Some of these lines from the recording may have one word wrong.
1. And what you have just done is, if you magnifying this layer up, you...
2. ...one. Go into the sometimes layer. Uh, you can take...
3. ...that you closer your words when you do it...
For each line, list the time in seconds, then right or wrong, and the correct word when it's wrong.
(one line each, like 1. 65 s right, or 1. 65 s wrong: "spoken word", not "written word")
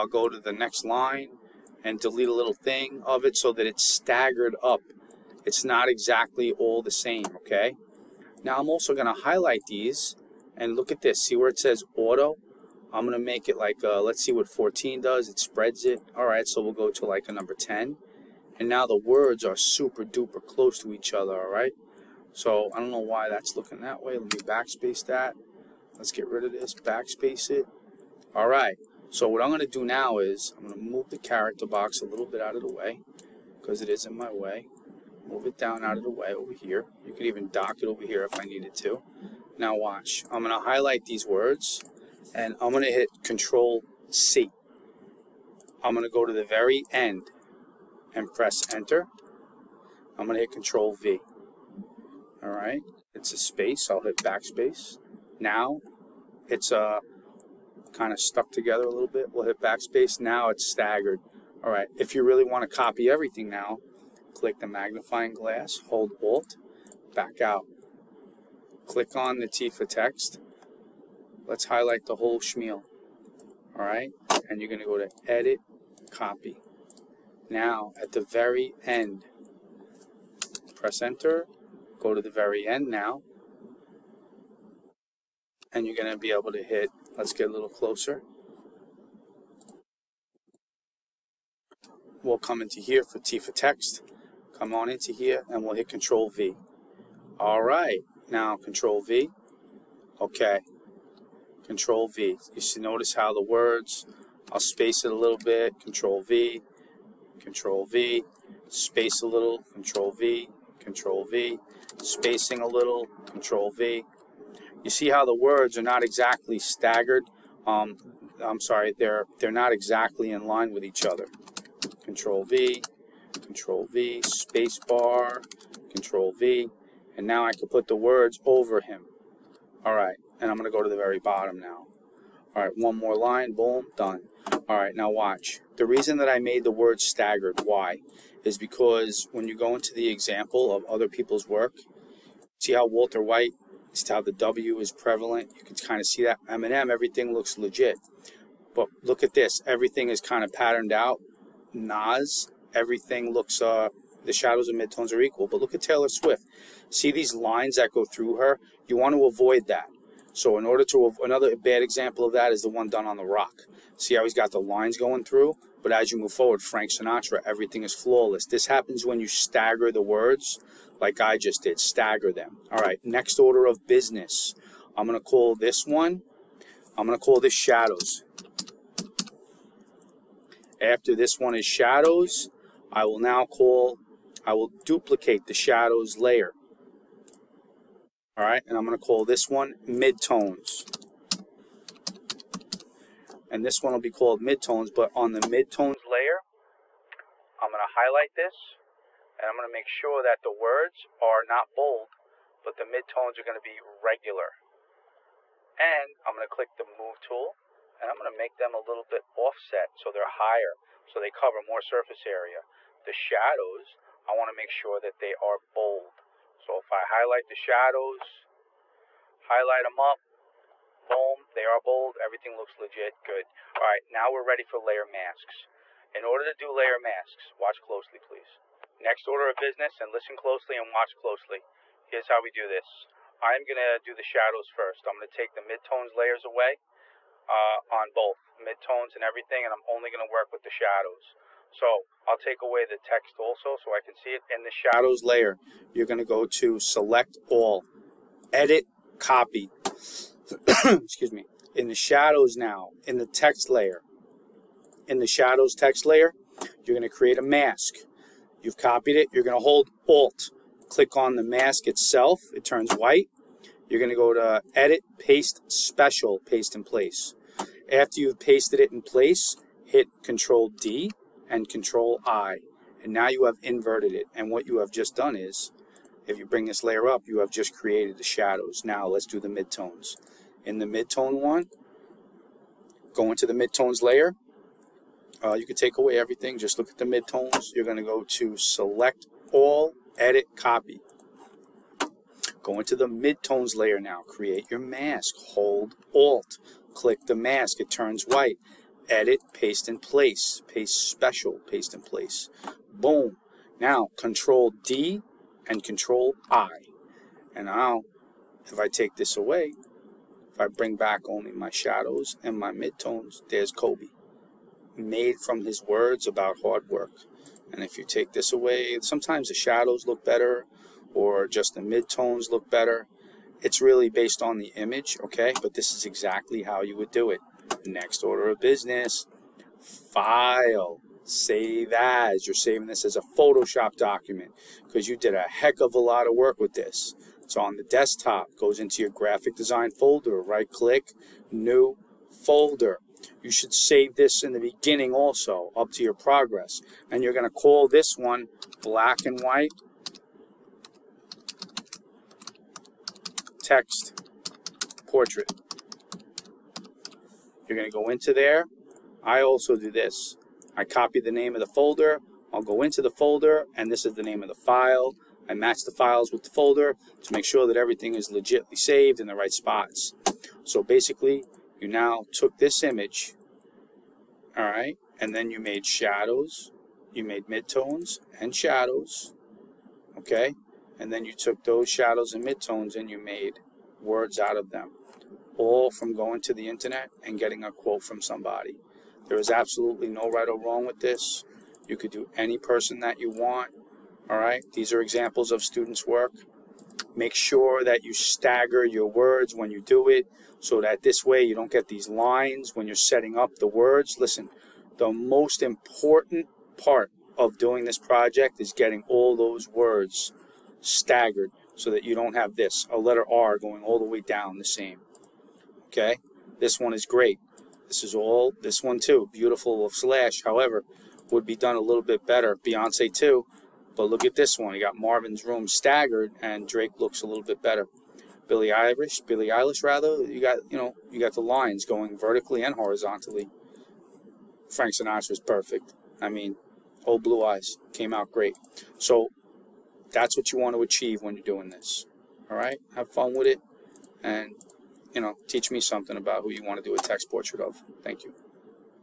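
1. 274 s wrong: "bring", not "magnifying"
2. 281 s wrong: "midtones", not "sometimes"
3. 397 s wrong: "stagger", not "closer".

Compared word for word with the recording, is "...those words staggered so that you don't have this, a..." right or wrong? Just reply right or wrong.
right.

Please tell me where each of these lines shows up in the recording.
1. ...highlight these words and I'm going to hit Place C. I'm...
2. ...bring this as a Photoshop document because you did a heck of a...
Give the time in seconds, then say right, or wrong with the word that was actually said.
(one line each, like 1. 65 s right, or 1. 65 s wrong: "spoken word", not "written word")
1. 40 s wrong: "Control", not "Place"
2. 332 s wrong: "saving", not "bring".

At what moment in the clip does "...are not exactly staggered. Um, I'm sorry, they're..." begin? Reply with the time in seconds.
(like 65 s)
115 s.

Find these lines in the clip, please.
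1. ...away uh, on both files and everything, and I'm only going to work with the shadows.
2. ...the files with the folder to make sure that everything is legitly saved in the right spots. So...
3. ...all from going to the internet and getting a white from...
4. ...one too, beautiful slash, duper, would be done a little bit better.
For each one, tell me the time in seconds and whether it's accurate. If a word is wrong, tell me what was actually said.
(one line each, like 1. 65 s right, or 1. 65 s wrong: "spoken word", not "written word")
1. 236 s wrong: "midtones", not "files"
2. 365 s right
3. 385 s wrong: "quote", not "white"
4. 418 s wrong: "however", not "duper".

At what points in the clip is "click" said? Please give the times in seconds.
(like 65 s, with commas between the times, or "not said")
64 s, 68 s, 206 s, 260 s, 296 s, 340 s.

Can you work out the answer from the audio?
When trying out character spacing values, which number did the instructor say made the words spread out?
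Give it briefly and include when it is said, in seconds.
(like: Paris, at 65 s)
14, at 14 s.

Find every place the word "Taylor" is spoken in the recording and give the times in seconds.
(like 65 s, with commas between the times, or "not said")
155 s.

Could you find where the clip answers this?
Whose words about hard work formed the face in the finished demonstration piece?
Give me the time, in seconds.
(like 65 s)
313 s.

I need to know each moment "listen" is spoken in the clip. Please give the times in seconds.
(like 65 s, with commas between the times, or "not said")
230 s, 404 s.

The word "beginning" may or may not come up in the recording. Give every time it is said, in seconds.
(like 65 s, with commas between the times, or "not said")
344 s.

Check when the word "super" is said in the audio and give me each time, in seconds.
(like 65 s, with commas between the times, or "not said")
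19 s.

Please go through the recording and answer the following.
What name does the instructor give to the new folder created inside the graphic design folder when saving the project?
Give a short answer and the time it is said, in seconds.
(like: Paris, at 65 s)
black and white text portrait, at 348 s.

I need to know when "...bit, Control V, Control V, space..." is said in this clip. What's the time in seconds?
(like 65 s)
105 s.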